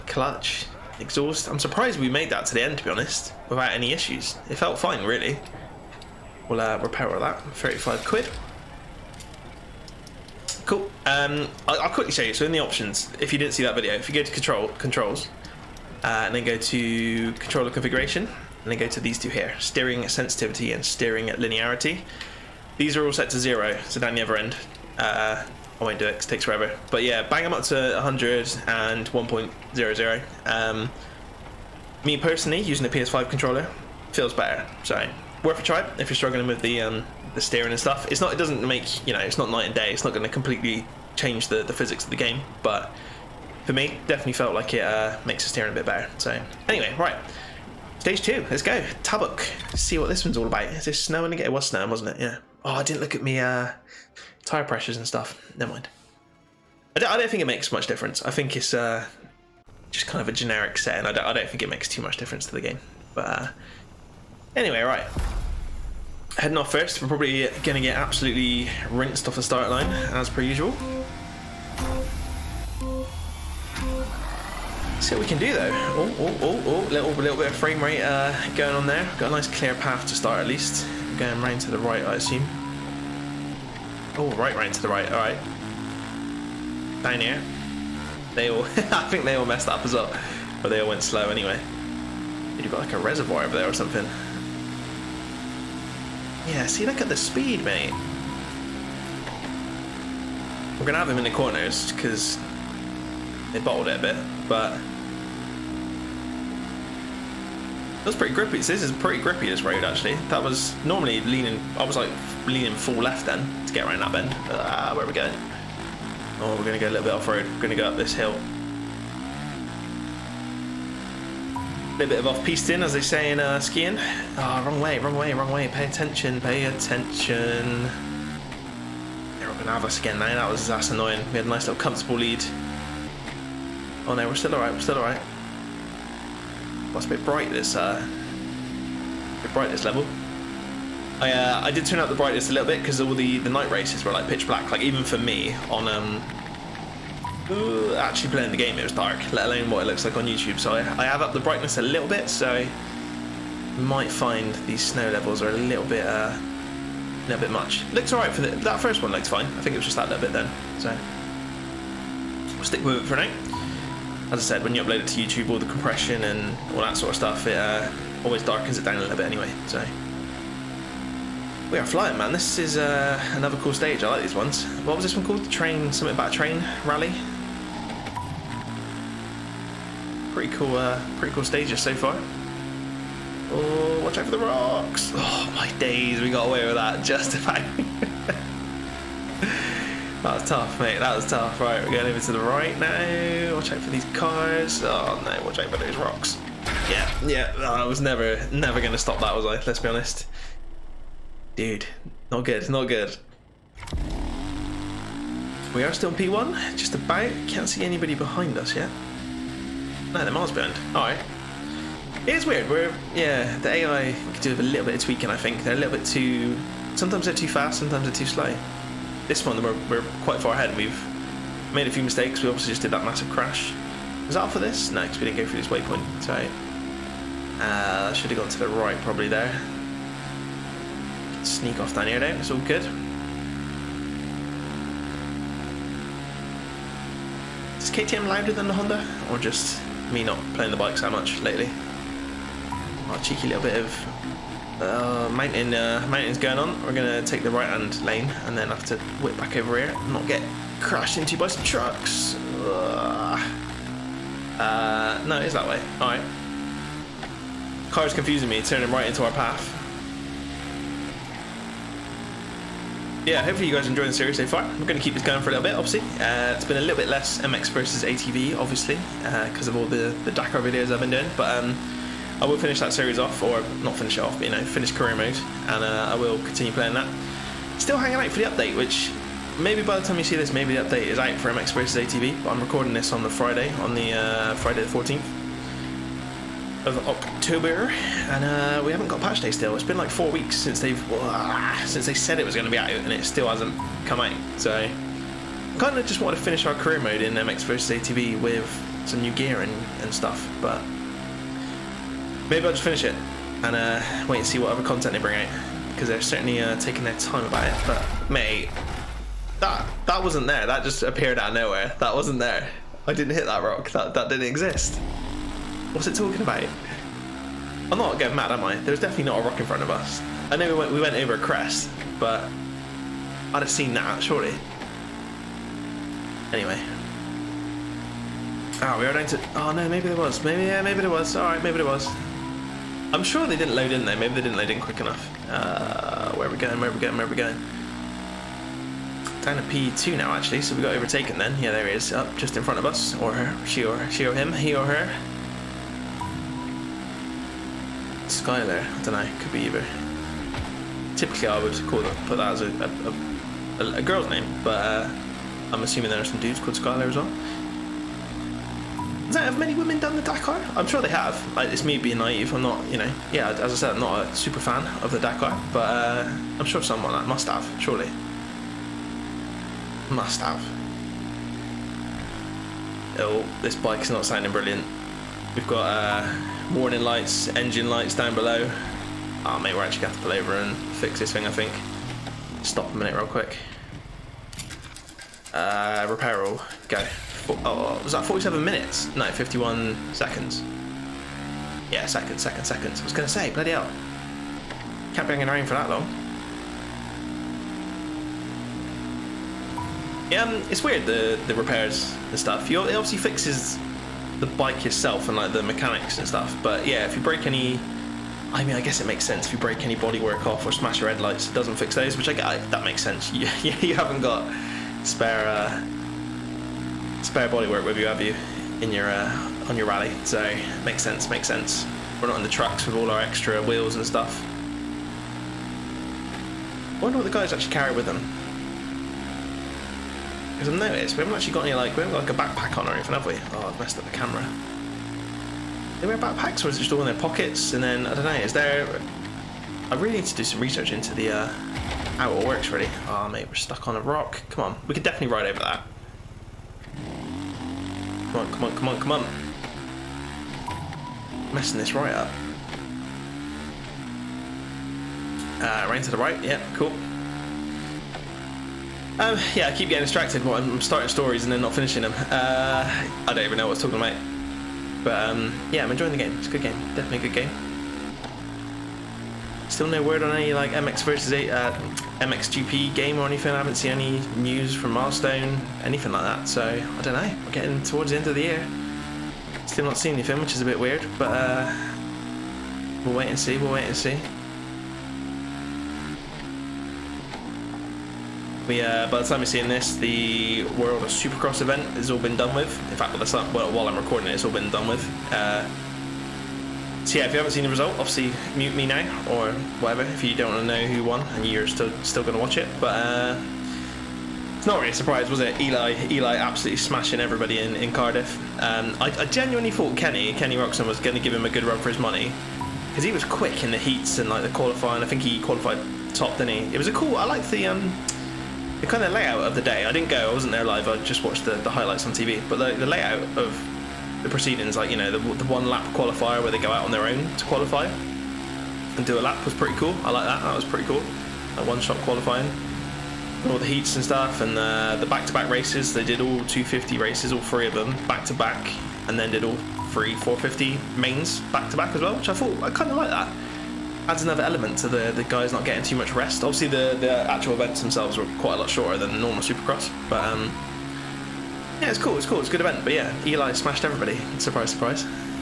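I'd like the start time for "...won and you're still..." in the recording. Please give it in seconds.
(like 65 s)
501 s.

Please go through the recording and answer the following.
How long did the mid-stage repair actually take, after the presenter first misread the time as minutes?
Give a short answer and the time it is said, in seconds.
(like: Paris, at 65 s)
51 seconds, at 389 s.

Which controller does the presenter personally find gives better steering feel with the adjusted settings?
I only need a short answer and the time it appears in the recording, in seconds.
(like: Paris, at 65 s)
PS5 controller, at 32 s.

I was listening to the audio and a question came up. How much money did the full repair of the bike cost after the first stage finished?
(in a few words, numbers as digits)
35 quid.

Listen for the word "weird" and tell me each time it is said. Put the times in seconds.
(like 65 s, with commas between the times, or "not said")
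212 s, 400 s, 480 s.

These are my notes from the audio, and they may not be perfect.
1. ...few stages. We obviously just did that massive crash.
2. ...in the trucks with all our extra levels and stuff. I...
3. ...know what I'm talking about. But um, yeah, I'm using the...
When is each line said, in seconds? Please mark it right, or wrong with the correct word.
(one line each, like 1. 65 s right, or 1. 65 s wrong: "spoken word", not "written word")
1. 221 s wrong: "mistakes", not "stages"
2. 422 s wrong: "wheels", not "levels"
3. 463 s wrong: "enjoying", not "using".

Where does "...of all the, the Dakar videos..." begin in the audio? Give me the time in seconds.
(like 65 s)
269 s.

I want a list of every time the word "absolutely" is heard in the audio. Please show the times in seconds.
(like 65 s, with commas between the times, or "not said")
67 s, 506 s.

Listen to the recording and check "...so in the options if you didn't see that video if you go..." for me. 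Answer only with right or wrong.
right.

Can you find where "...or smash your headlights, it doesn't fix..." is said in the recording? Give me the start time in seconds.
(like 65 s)
410 s.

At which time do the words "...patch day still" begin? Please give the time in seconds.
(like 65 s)
289 s.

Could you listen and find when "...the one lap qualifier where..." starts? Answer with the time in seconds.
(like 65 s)
525 s.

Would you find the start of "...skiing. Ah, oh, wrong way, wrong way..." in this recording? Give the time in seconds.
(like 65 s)
123 s.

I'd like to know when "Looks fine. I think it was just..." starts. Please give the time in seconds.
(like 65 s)
159 s.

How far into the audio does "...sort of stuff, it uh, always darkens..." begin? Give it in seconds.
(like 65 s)
166 s.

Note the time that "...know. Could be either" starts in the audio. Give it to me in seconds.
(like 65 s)
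349 s.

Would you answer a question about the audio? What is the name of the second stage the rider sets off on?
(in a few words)
Tabuk.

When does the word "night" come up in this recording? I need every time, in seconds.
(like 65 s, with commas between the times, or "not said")
39 s, 143 s.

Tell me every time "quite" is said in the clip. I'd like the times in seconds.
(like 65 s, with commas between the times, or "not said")
220 s, 548 s.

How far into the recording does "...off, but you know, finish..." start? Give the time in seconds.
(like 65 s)
274 s.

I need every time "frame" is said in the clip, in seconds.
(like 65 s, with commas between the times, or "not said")
77 s.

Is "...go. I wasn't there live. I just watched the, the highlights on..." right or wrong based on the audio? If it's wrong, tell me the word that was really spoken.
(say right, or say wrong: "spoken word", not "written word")
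right.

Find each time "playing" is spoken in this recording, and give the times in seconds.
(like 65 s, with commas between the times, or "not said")
148 s, 240 s, 276 s.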